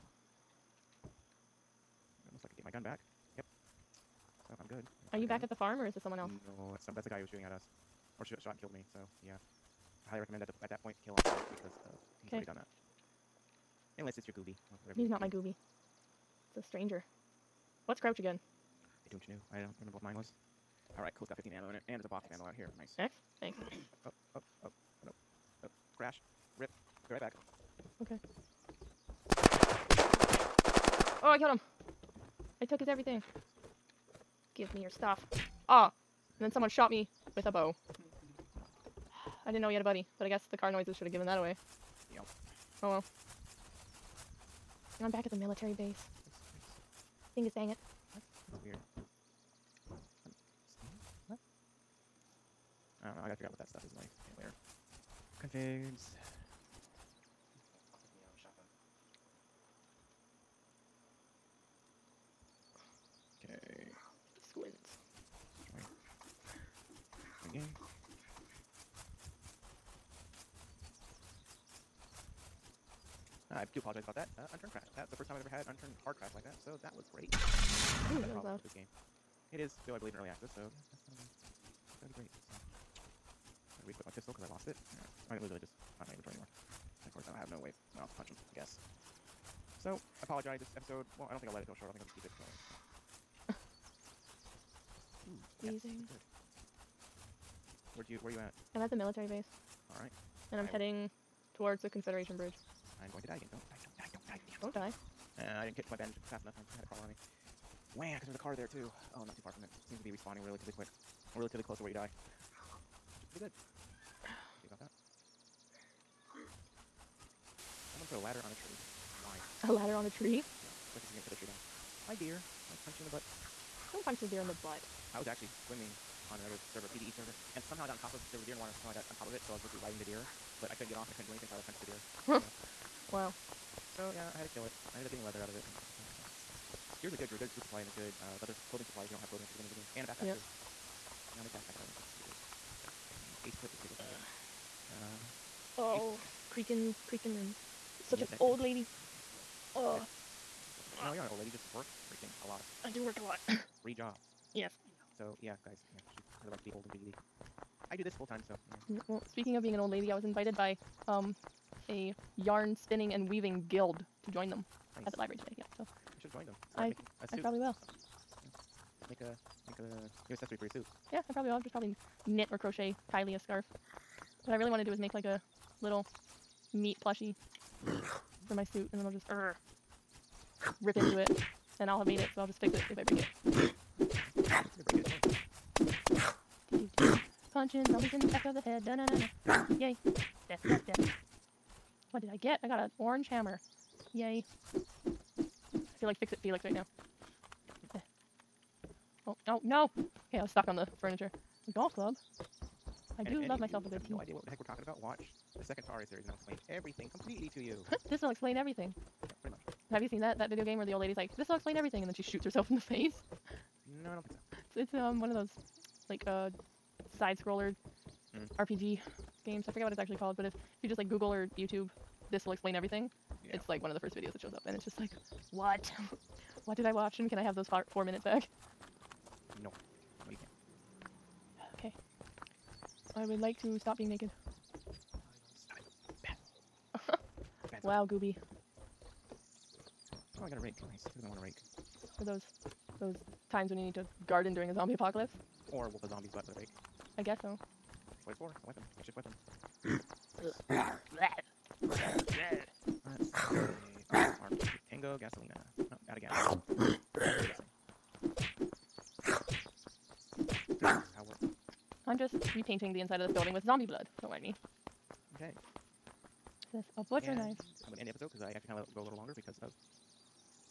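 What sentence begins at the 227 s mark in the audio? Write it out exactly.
And can I have those four minutes back?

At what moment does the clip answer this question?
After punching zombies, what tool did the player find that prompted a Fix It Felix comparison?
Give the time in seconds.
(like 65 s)
192 s.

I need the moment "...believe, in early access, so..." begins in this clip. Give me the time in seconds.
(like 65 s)
79 s.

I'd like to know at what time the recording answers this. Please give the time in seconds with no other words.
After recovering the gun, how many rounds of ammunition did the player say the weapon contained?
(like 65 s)
21 s.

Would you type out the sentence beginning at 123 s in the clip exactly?
Don't punch the deer in the butt.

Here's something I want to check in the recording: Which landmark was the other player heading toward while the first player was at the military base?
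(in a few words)
Confederation Bridge.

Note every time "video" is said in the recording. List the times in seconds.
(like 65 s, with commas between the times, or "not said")
210 s, 224 s.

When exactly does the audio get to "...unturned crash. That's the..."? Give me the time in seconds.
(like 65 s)
74 s.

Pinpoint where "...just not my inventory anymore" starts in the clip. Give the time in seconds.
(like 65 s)
85 s.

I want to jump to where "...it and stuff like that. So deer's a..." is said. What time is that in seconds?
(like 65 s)
135 s.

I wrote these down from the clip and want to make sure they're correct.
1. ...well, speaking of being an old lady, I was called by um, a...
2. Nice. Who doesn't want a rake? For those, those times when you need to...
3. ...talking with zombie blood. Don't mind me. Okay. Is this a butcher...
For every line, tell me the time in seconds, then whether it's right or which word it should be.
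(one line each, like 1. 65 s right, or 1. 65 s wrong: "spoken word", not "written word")
1. 159 s wrong: "invited", not "called"
2. 240 s right
3. 263 s wrong: "building", not "talking".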